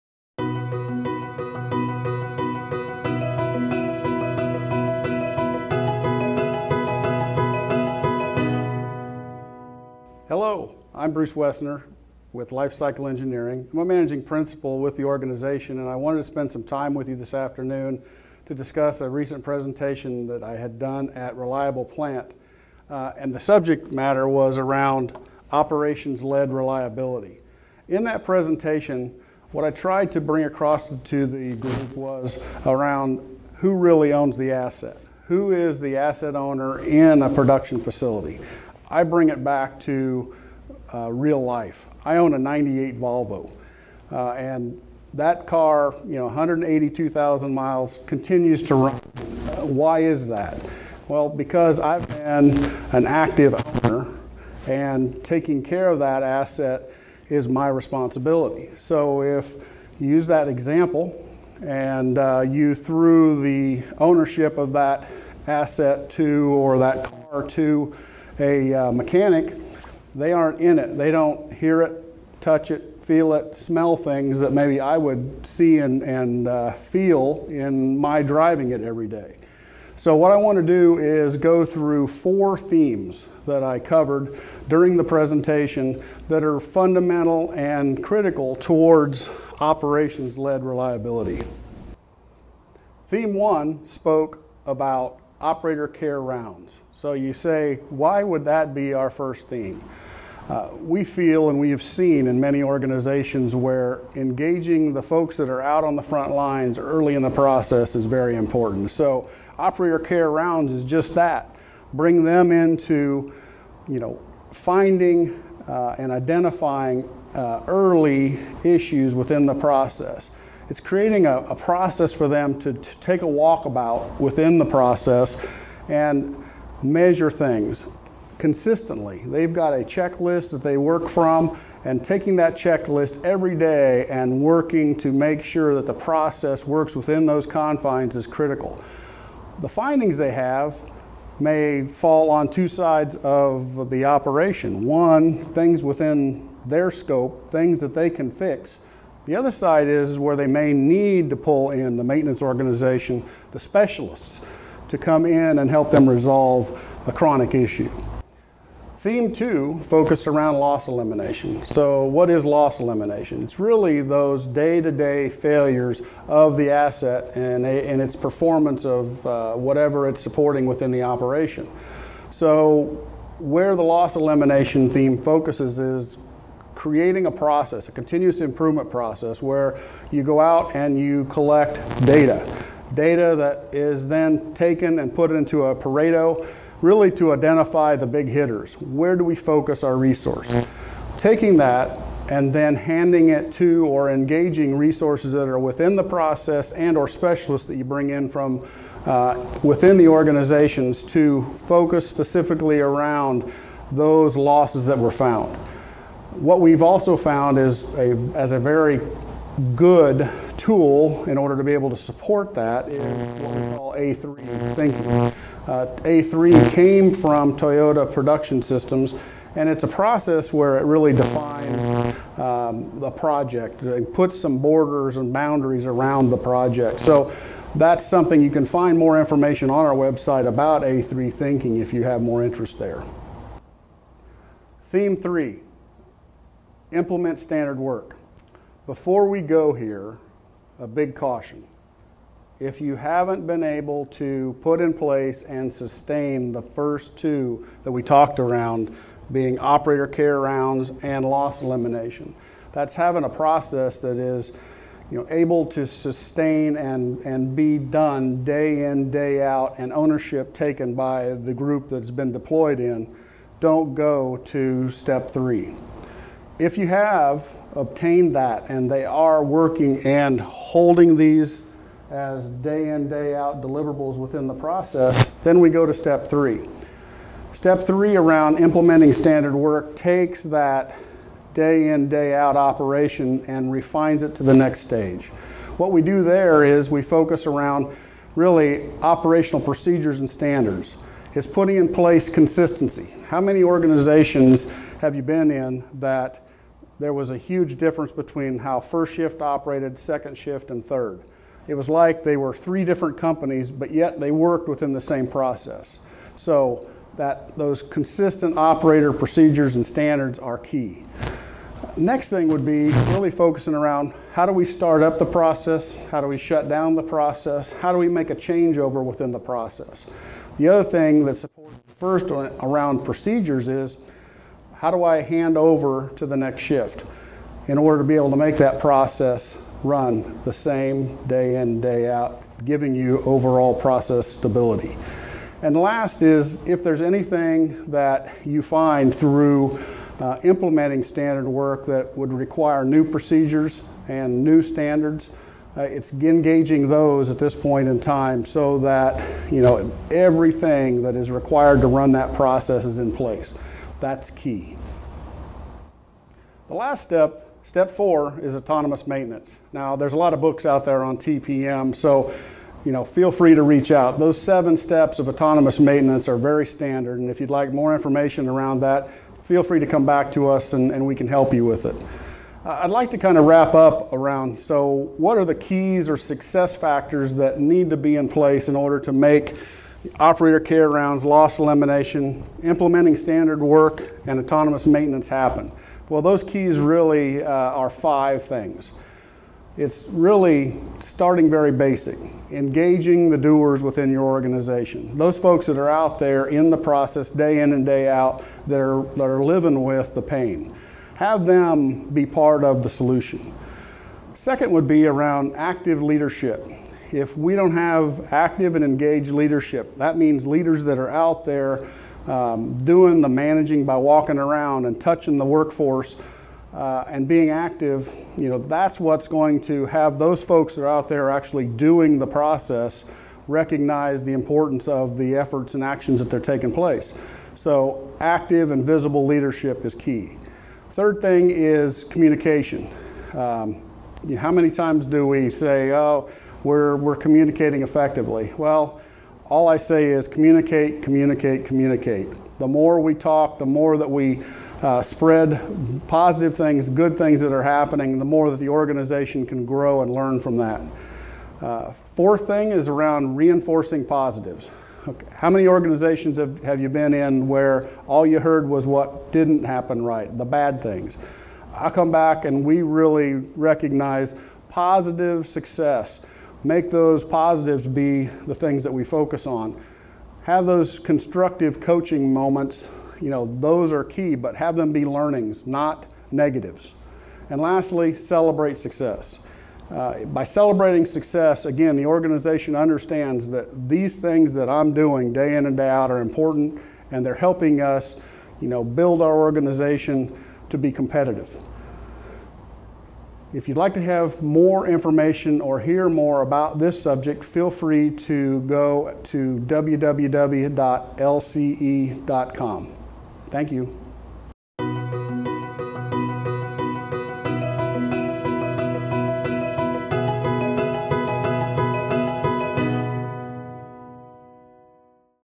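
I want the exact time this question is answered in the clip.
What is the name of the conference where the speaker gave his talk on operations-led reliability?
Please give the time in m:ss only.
0:21.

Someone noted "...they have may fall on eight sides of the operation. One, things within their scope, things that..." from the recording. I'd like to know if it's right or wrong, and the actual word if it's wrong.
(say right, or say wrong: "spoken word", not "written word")
wrong: "two", not "eight".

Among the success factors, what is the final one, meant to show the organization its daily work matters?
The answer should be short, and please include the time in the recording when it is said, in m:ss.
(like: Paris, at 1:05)
Celebrate success, at 7:58.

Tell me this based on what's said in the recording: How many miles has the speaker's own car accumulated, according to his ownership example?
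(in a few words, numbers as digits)
182,000.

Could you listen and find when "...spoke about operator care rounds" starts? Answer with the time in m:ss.
1:33.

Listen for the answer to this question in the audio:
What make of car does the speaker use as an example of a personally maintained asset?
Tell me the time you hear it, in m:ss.
0:42.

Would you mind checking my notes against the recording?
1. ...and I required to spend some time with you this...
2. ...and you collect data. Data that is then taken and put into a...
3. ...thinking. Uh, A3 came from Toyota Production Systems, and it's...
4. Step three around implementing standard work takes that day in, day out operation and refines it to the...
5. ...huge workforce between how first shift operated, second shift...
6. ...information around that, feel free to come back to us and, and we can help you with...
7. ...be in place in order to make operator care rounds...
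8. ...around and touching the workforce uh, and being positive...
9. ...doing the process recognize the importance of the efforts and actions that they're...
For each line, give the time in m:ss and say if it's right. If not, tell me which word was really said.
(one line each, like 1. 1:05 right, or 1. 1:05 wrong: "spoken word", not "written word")
1. 0:15 wrong: "wanted", not "required"
2. 3:00 right
3. 3:34 right
4. 4:37 right
5. 4:57 wrong: "difference", not "workforce"
6. 6:07 right
7. 6:17 right
8. 6:54 wrong: "active", not "positive"
9. 7:01 right.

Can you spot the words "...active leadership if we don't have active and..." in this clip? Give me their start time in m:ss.
6:45.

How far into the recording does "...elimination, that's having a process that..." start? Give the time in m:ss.
4:11.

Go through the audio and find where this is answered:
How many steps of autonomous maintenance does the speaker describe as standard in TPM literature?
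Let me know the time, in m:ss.
6:04.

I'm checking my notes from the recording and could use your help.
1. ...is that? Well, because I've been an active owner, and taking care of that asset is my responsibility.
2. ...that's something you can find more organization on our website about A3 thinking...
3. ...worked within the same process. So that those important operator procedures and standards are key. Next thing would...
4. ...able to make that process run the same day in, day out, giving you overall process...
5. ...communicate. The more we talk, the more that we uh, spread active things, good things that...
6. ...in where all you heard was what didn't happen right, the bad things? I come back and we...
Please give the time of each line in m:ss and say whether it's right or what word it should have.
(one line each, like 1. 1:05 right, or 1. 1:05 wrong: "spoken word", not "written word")
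1. 0:49 right
2. 3:47 wrong: "information", not "organization"
3. 5:04 wrong: "consistent", not "important"
4. 5:28 right
5. 7:21 wrong: "positive", not "active"
6. 7:37 right.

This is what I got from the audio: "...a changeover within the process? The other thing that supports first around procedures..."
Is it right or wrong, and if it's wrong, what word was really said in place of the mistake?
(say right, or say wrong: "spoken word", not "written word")
right.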